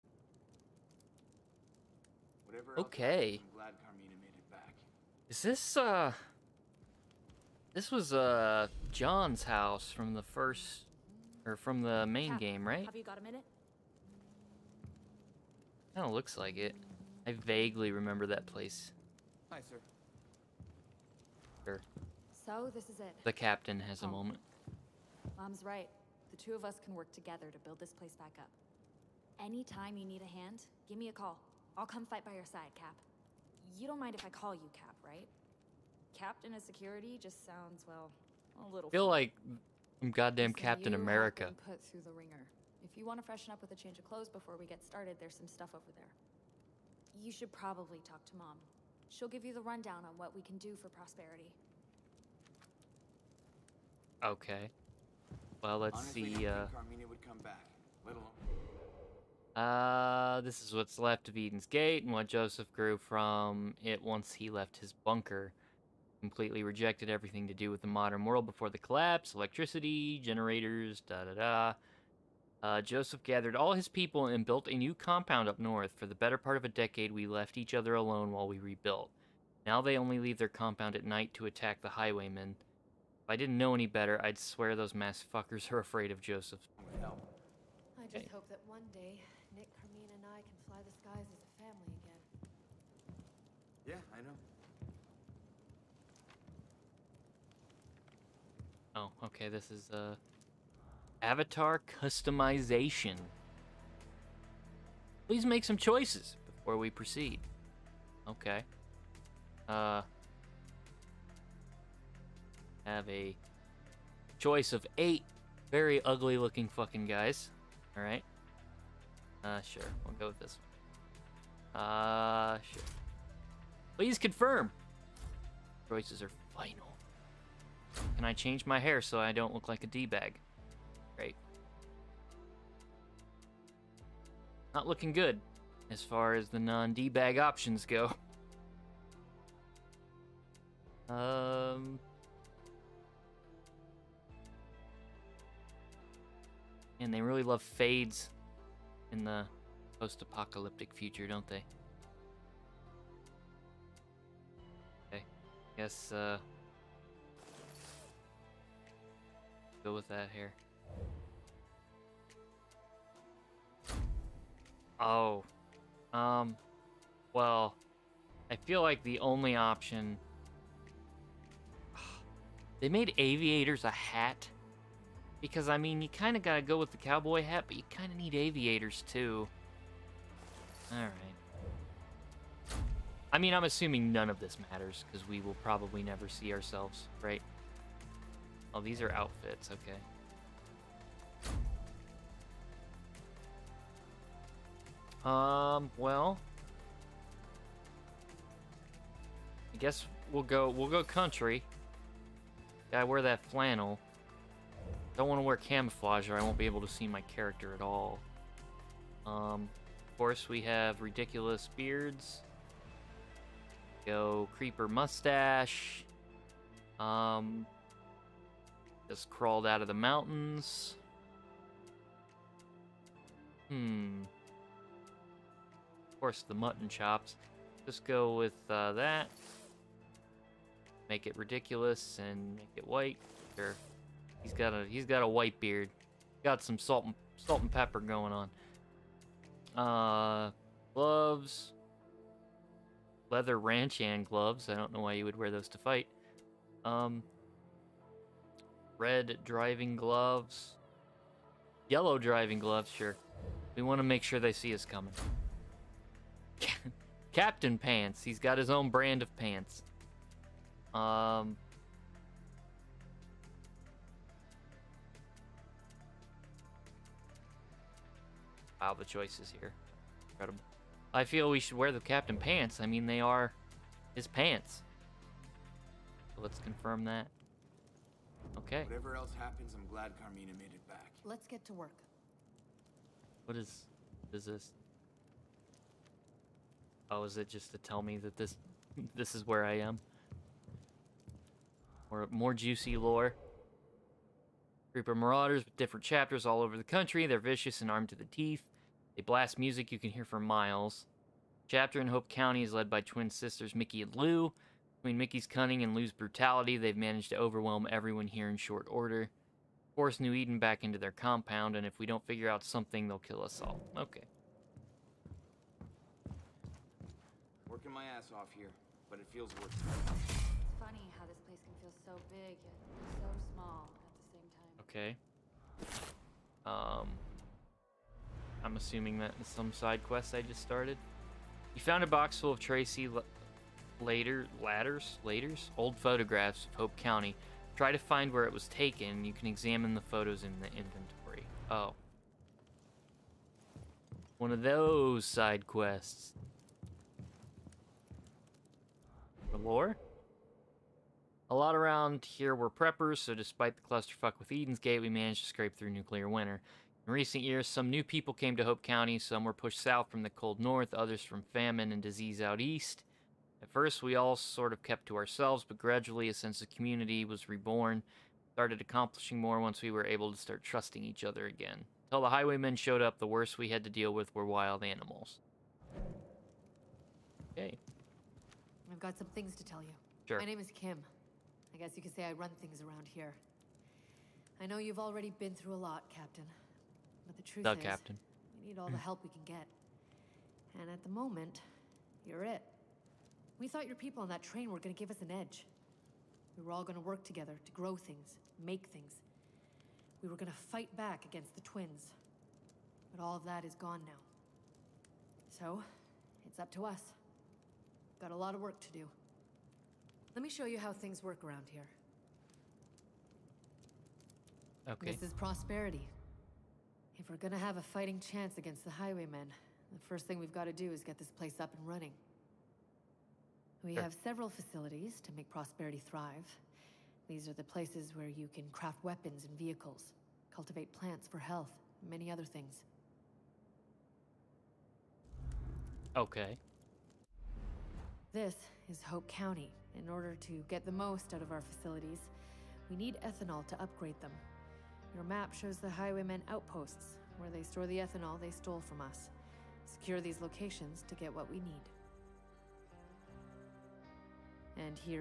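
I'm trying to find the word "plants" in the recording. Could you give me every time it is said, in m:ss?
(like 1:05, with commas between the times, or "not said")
7:10.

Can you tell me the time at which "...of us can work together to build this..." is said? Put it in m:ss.
0:26.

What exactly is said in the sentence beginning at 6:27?
But the truth the is, Captain.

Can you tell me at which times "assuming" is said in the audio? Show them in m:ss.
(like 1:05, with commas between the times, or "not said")
3:03, 5:28.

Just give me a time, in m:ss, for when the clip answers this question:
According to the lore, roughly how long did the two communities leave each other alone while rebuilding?
1:16.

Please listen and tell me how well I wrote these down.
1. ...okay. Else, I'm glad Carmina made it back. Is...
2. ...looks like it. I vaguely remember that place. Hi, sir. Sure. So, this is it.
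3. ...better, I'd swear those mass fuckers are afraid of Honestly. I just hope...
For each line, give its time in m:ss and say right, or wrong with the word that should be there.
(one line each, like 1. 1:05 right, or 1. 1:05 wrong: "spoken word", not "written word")
1. 0:02 right
2. 0:16 right
3. 1:23 wrong: "Joseph", not "Honestly".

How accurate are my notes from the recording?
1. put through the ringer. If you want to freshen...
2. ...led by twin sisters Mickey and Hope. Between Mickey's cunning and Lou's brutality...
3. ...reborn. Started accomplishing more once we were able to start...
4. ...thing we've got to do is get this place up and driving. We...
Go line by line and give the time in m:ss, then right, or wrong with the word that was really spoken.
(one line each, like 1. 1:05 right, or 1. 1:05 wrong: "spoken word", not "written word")
1. 0:41 right
2. 5:02 wrong: "Lou", not "Hope"
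3. 6:07 right
4. 7:00 wrong: "running", not "driving".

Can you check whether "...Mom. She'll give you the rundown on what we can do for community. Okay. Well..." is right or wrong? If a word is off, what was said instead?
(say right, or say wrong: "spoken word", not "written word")
wrong: "prosperity", not "community".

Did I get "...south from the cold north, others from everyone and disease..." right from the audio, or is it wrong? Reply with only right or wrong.
wrong.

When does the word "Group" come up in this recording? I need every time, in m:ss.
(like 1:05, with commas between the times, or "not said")
4:54.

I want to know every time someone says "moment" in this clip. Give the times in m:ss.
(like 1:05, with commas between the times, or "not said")
0:24, 6:31.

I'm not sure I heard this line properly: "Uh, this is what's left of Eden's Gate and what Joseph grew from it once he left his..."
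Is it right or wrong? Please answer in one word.
right.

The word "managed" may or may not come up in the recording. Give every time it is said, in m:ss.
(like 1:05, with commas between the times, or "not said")
5:06, 5:55.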